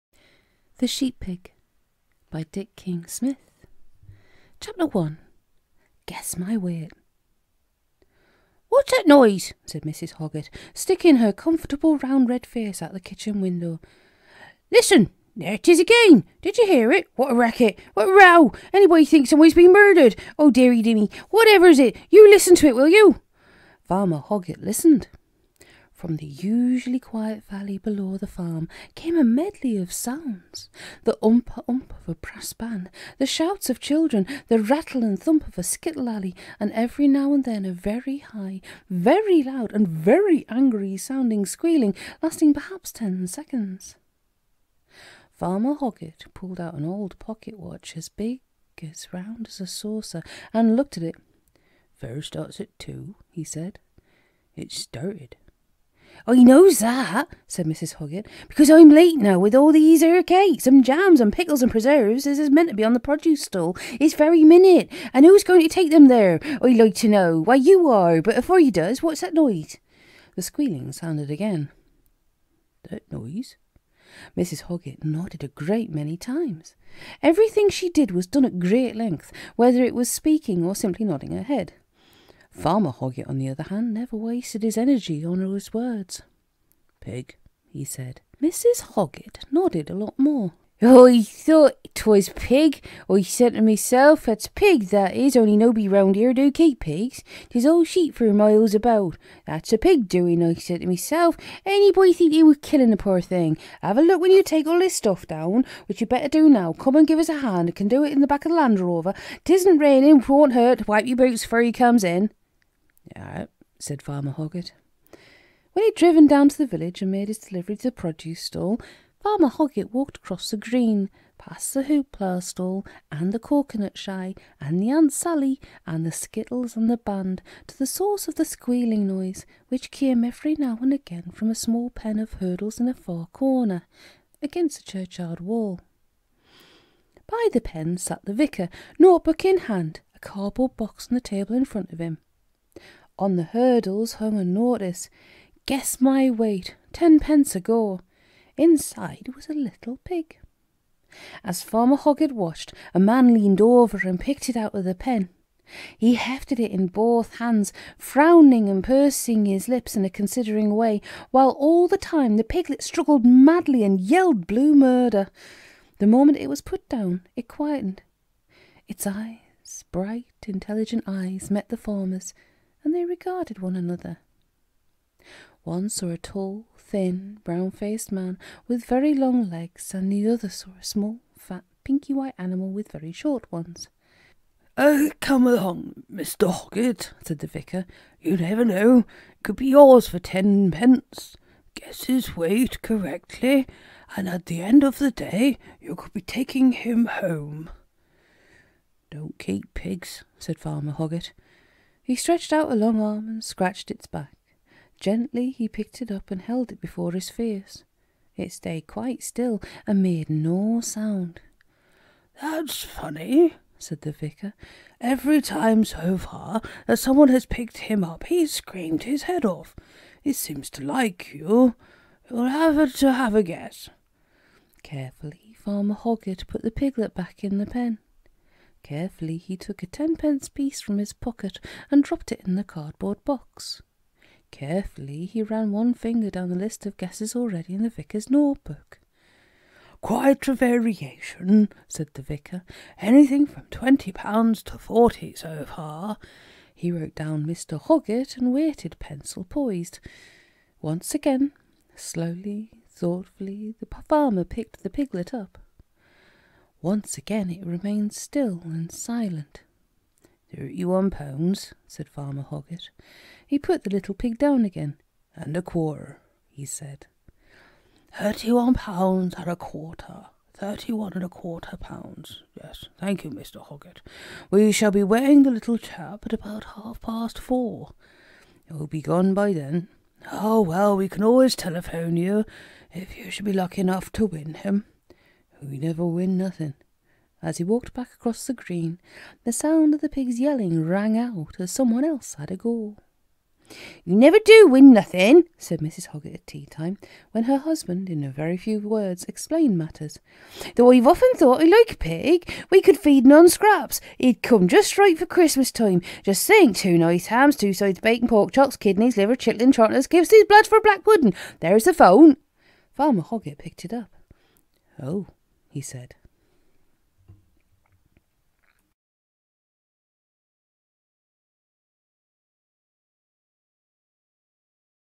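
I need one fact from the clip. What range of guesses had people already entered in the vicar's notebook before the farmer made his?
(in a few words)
20 to 40 pounds.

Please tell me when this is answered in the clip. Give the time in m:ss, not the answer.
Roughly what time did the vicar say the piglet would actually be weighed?
4:36.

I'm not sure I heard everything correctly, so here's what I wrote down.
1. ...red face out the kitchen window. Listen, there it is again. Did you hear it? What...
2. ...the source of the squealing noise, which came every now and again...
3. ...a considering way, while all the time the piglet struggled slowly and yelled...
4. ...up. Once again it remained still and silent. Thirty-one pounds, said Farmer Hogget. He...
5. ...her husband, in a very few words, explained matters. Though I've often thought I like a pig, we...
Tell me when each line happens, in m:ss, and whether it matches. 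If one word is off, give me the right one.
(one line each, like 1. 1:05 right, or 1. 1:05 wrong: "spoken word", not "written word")
1. 0:12 right
2. 2:07 right
3. 2:40 wrong: "madly", not "slowly"
4. 4:15 right
5. 4:57 right.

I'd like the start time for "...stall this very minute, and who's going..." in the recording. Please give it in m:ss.
1:03.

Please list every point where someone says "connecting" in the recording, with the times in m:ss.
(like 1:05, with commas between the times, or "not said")
not said.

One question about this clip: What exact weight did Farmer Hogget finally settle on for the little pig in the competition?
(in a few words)
31¼ pounds.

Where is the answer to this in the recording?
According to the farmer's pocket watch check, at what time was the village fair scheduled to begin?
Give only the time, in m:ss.
0:51.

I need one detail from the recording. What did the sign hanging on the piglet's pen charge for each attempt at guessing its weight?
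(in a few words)
10 pence.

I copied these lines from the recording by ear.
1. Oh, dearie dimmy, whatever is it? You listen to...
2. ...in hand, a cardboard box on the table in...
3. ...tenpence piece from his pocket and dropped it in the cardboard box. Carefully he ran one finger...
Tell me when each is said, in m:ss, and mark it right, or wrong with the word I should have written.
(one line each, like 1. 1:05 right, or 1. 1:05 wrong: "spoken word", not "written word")
1. 0:20 right
2. 2:19 right
3. 3:49 right.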